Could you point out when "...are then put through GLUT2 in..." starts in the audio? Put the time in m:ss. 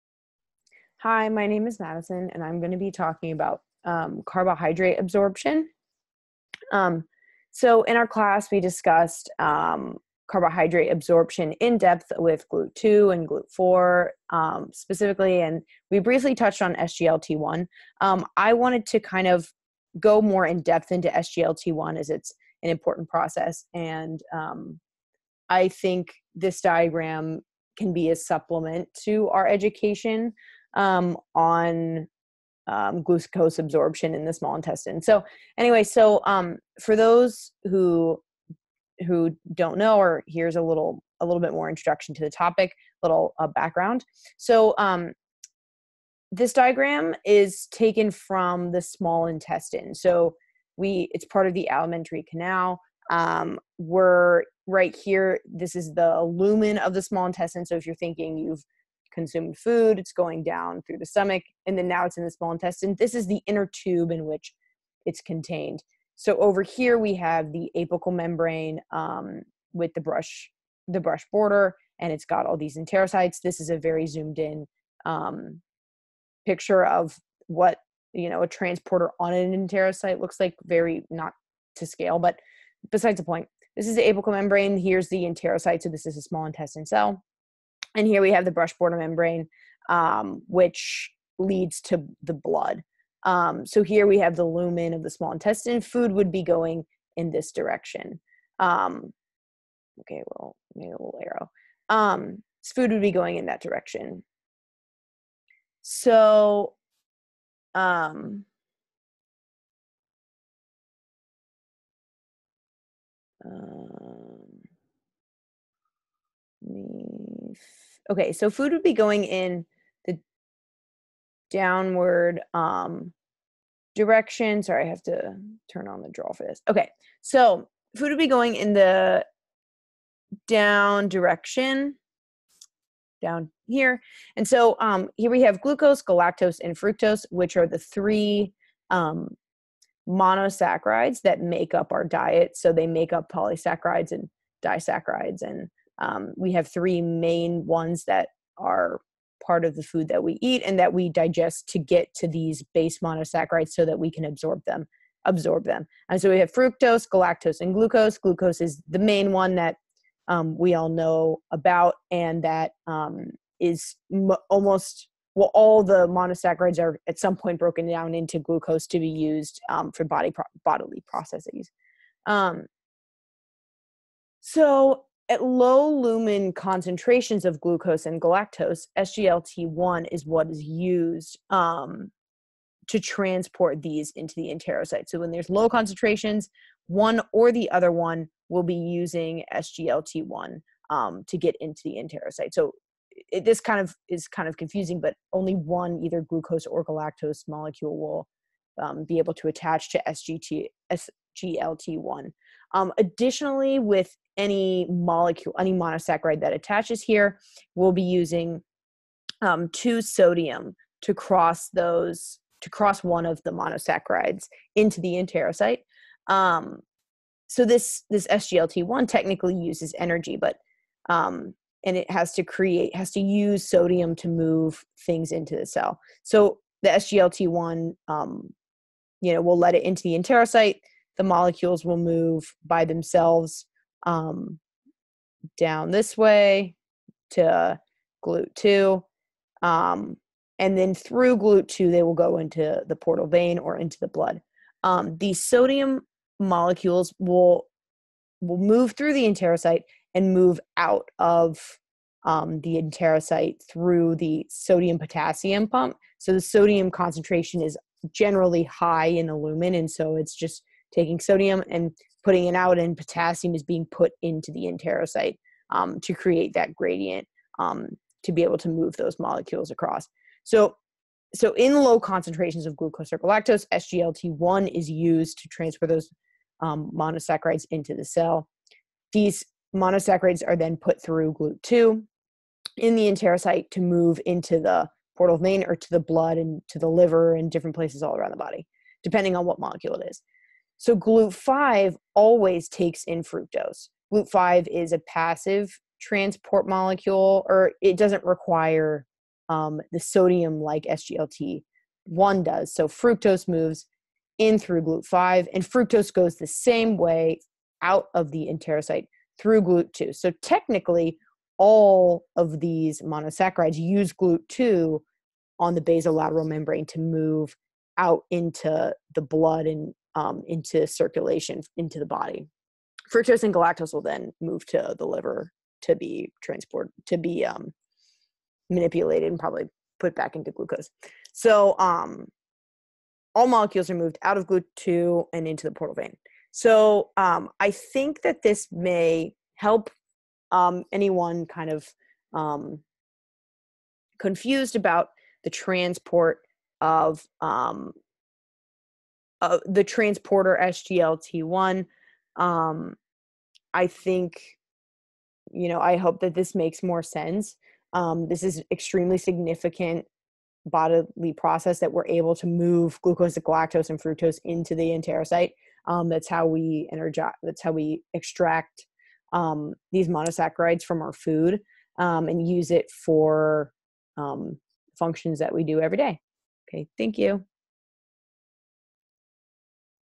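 4:40.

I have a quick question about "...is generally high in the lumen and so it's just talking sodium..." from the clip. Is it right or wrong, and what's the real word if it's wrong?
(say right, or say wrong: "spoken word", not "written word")
wrong: "taking", not "talking".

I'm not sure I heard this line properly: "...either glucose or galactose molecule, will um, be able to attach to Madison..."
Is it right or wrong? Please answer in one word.
wrong.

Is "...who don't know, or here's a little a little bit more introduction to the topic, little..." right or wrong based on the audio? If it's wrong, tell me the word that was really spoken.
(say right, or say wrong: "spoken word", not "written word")
right.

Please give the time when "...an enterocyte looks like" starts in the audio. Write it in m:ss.
1:19.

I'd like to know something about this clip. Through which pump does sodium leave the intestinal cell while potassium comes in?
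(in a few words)
sodium potassium pump.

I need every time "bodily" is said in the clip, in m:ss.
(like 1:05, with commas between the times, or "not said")
2:50, 6:00.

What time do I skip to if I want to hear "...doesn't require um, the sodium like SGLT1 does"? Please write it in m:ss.
4:57.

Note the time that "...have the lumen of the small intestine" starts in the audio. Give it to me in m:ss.
1:34.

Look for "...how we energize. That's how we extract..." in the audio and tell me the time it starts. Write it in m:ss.
6:06.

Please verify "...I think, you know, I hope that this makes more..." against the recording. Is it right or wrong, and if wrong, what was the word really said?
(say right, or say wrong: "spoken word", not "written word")
right.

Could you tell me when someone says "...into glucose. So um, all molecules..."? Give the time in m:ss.
5:30.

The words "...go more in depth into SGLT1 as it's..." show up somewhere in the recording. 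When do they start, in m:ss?
0:19.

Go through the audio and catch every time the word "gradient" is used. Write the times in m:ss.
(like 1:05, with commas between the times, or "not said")
4:26.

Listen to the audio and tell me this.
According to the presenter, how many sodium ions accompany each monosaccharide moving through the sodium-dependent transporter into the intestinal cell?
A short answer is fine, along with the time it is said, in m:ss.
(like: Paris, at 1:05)
2, at 3:29.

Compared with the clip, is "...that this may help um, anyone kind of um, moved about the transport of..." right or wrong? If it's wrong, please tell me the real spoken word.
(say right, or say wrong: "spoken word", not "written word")
wrong: "confused", not "moved".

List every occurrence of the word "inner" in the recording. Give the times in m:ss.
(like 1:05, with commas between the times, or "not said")
1:03.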